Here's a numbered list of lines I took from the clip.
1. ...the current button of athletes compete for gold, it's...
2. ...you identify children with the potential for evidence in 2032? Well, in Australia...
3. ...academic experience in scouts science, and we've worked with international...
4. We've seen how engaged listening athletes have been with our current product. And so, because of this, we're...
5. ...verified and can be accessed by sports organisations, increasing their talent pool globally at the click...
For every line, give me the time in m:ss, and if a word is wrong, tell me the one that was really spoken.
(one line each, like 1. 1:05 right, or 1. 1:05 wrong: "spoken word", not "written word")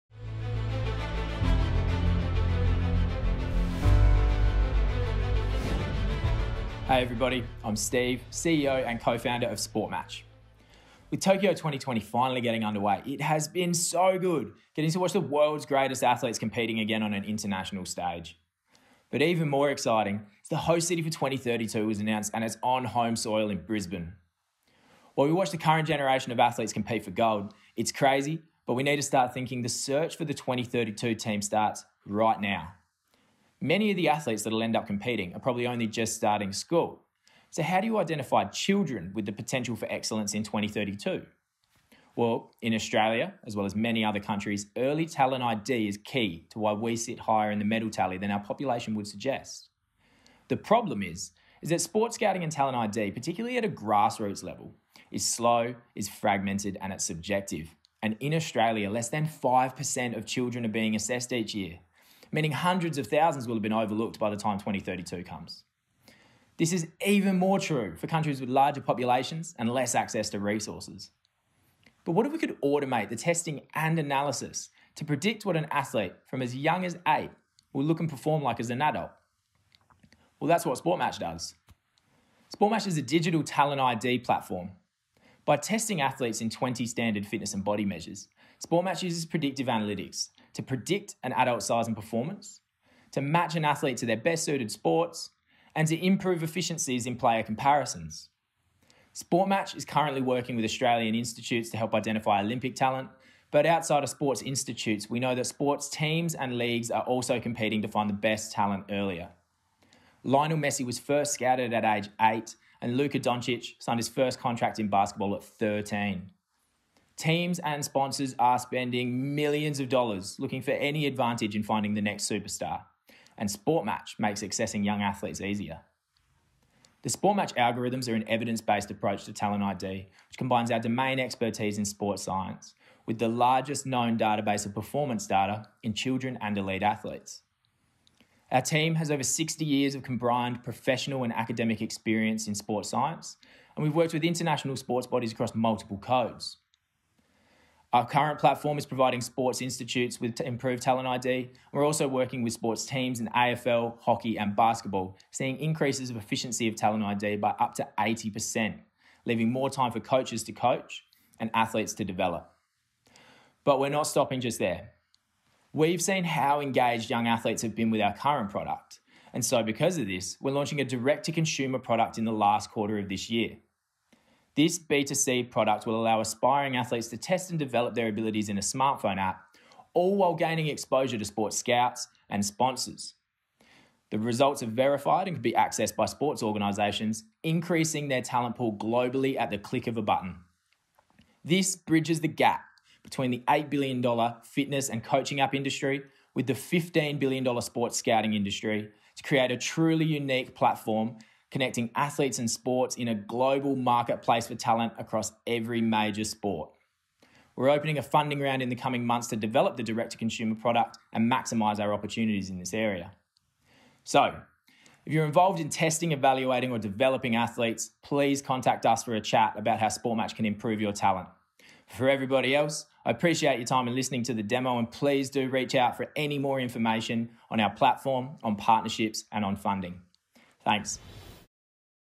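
1. 0:25 wrong: "generation", not "button"
2. 0:37 wrong: "excellence", not "evidence"
3. 2:21 wrong: "sports", not "scouts"
4. 2:45 wrong: "young", not "listening"
5. 3:04 right.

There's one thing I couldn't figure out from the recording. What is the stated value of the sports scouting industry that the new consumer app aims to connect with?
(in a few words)
$15 billion.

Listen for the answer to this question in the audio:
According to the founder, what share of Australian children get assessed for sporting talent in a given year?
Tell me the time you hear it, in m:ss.
0:58.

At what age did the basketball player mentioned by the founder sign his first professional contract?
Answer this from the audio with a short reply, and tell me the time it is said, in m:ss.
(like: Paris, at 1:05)
13, at 1:55.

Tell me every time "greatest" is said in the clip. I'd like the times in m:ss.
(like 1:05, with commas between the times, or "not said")
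0:15.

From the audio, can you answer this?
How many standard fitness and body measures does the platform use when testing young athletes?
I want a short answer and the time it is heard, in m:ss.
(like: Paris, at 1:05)
20, at 1:26.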